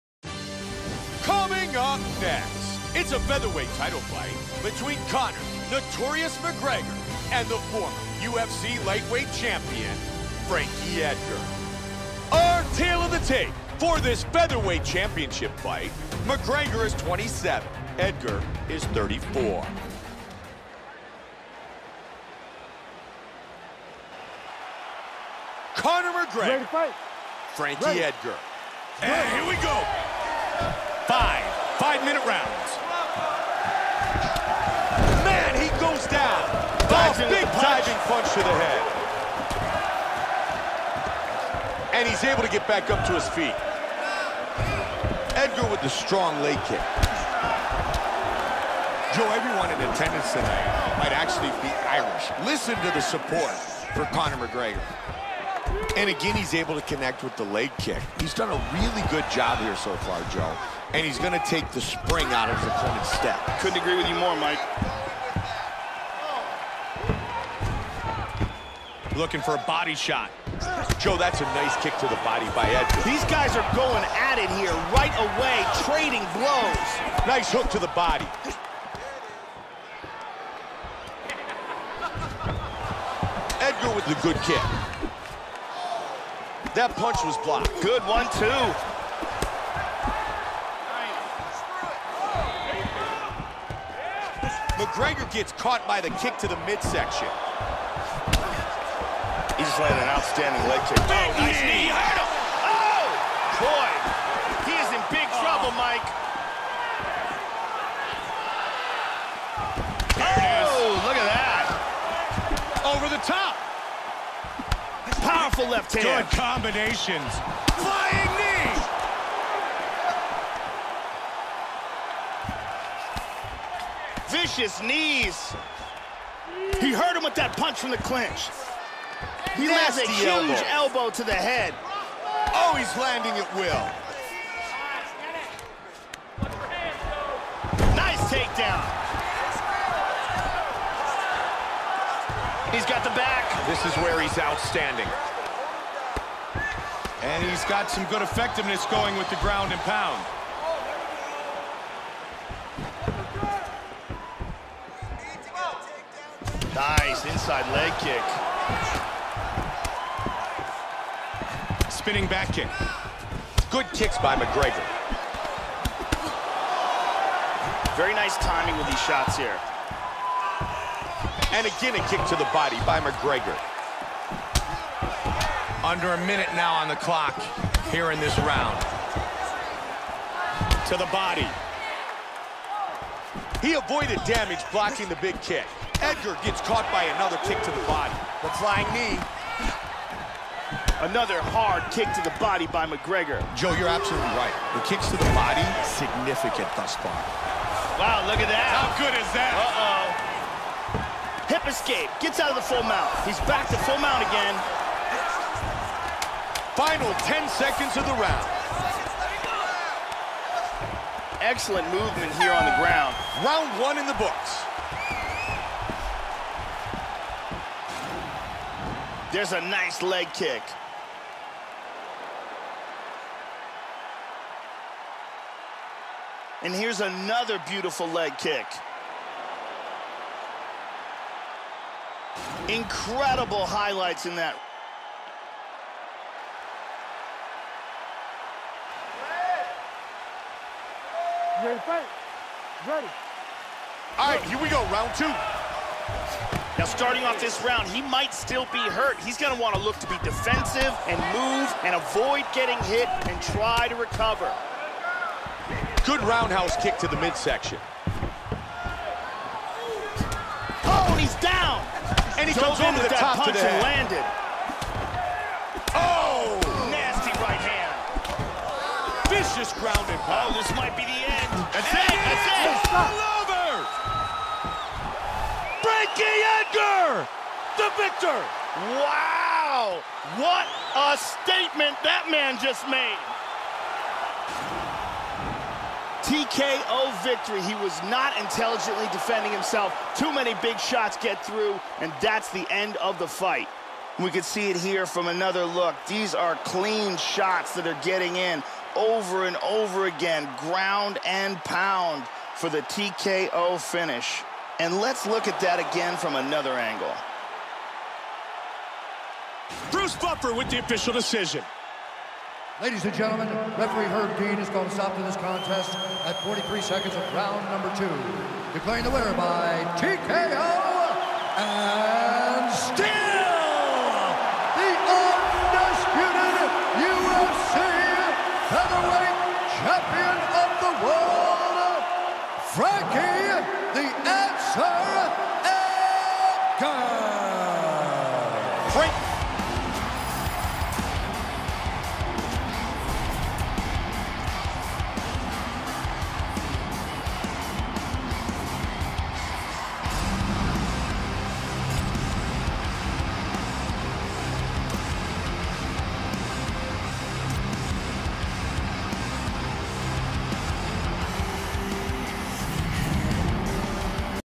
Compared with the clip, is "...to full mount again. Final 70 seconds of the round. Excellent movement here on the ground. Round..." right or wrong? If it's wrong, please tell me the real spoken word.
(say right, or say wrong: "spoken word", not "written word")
wrong: "10", not "70".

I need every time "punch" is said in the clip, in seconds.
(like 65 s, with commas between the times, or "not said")
38 s, 86 s, 127 s, 263 s.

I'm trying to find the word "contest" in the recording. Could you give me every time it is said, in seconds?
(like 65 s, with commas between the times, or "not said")
315 s.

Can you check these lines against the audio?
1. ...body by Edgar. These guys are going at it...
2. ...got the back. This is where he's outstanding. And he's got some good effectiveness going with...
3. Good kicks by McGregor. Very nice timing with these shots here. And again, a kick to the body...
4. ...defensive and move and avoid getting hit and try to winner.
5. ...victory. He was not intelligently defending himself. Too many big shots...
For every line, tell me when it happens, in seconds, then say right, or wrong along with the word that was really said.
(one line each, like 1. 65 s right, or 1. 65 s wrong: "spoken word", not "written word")
1. 72 s right
2. 142 s right
3. 163 s right
4. 250 s wrong: "recover", not "winner"
5. 287 s right.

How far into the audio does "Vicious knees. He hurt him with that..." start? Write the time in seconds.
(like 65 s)
124 s.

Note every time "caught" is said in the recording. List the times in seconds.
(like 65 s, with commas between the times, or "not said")
95 s, 186 s.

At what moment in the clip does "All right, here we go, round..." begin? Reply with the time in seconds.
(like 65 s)
244 s.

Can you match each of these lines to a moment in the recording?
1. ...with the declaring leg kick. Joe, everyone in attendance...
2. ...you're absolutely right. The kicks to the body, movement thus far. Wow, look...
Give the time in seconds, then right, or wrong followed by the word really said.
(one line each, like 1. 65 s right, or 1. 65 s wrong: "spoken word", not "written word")
1. 45 s wrong: "strong", not "declaring"
2. 193 s wrong: "significant", not "movement".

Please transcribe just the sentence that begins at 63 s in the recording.
Couldn't agree with you more, Mike.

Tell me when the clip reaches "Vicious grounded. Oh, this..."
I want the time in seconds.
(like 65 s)
269 s.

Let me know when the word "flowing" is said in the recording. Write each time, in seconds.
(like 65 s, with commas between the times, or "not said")
not said.